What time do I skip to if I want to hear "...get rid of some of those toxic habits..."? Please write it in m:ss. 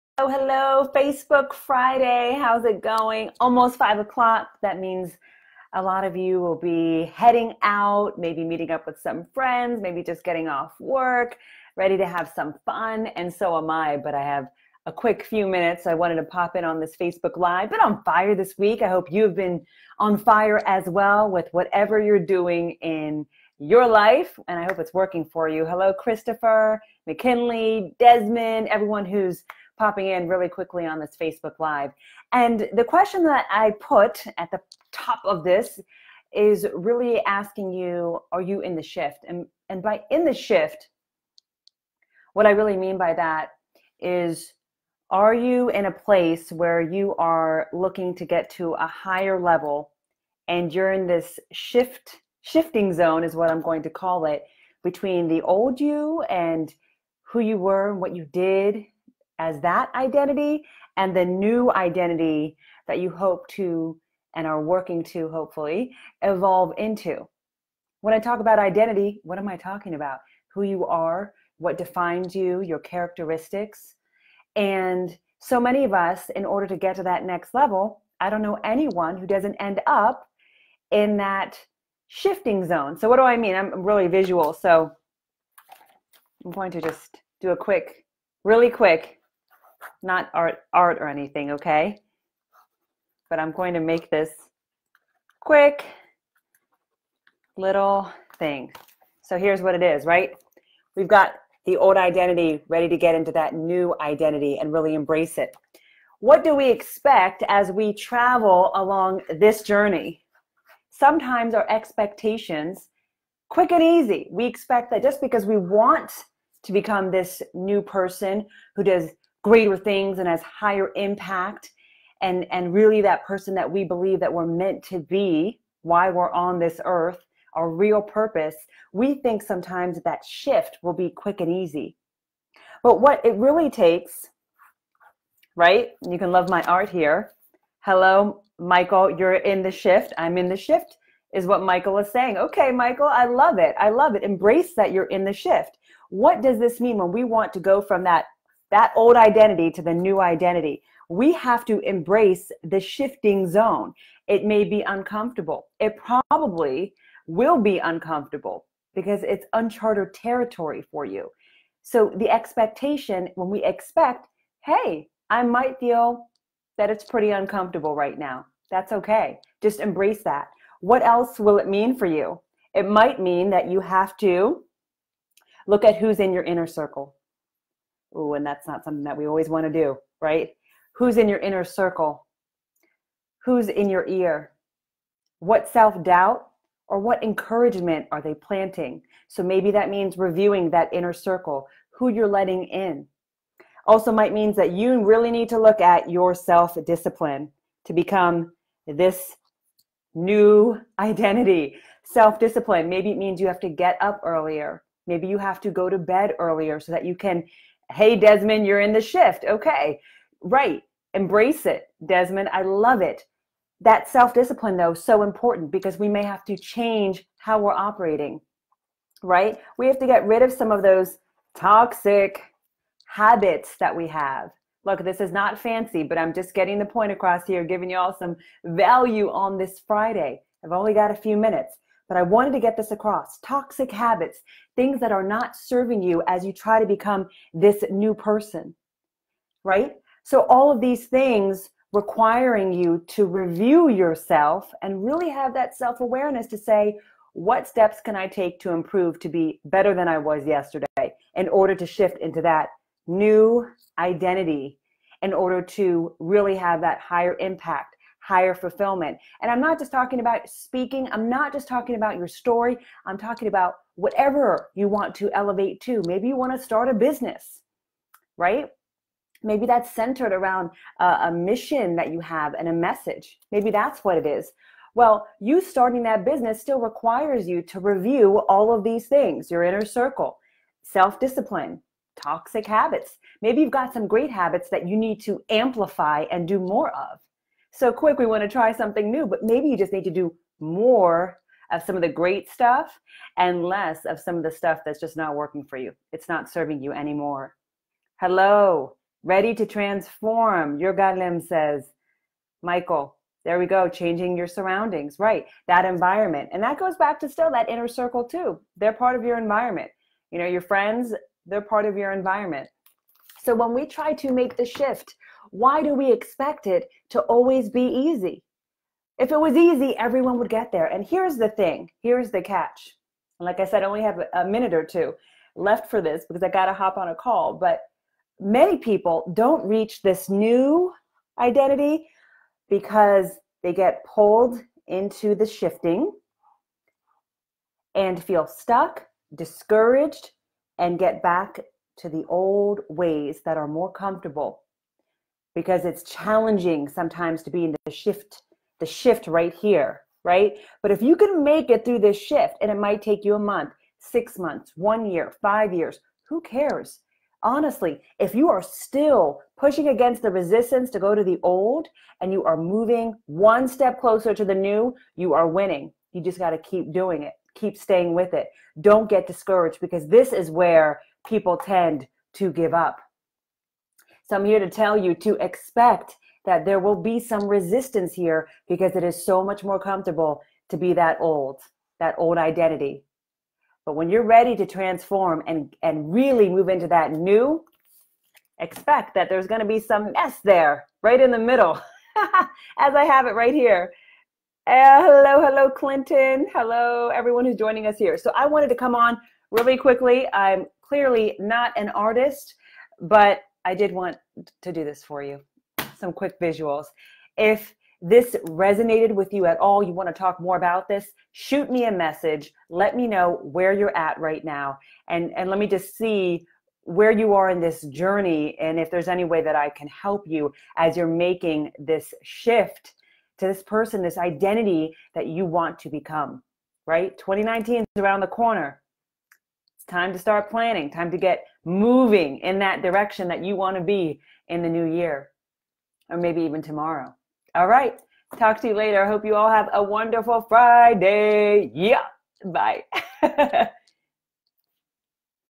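3:40.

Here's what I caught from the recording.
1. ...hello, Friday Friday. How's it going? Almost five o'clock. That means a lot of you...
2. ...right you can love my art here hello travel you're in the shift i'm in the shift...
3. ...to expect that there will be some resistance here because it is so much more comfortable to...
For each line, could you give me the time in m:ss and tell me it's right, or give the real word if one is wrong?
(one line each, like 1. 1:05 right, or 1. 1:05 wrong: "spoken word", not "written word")
1. 0:00 wrong: "Facebook", not "Friday"
2. 2:15 wrong: "michael", not "travel"
3. 6:15 right.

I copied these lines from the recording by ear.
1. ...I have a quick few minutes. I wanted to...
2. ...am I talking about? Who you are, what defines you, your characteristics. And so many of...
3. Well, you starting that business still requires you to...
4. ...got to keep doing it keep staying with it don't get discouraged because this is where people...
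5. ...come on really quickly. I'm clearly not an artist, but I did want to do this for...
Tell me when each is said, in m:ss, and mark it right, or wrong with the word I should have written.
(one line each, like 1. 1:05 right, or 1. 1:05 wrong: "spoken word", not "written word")
1. 0:14 right
2. 1:09 right
3. 4:34 right
4. 6:06 right
5. 6:38 right.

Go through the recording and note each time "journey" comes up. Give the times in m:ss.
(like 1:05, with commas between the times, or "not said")
1:49, 6:57.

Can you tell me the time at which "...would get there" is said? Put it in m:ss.
5:20.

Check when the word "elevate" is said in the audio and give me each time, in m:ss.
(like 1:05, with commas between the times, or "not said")
4:25.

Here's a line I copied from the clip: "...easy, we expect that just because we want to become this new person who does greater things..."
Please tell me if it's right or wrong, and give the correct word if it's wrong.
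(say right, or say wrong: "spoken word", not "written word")
right.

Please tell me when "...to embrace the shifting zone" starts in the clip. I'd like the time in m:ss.
2:31.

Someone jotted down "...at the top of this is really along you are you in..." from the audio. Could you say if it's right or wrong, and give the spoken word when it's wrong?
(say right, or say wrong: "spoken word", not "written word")
wrong: "asking", not "along".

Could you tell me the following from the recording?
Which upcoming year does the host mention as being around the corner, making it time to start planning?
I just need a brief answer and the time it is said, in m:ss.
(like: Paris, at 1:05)
2019, at 7:07.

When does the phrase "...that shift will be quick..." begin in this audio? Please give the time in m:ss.
2:10.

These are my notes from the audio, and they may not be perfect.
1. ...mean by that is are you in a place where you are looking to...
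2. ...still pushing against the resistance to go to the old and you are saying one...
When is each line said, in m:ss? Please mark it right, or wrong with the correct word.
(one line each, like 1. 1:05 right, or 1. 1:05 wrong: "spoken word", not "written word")
1. 0:42 right
2. 5:58 wrong: "moving", not "saying".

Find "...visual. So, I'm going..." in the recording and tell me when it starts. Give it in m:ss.
1:24.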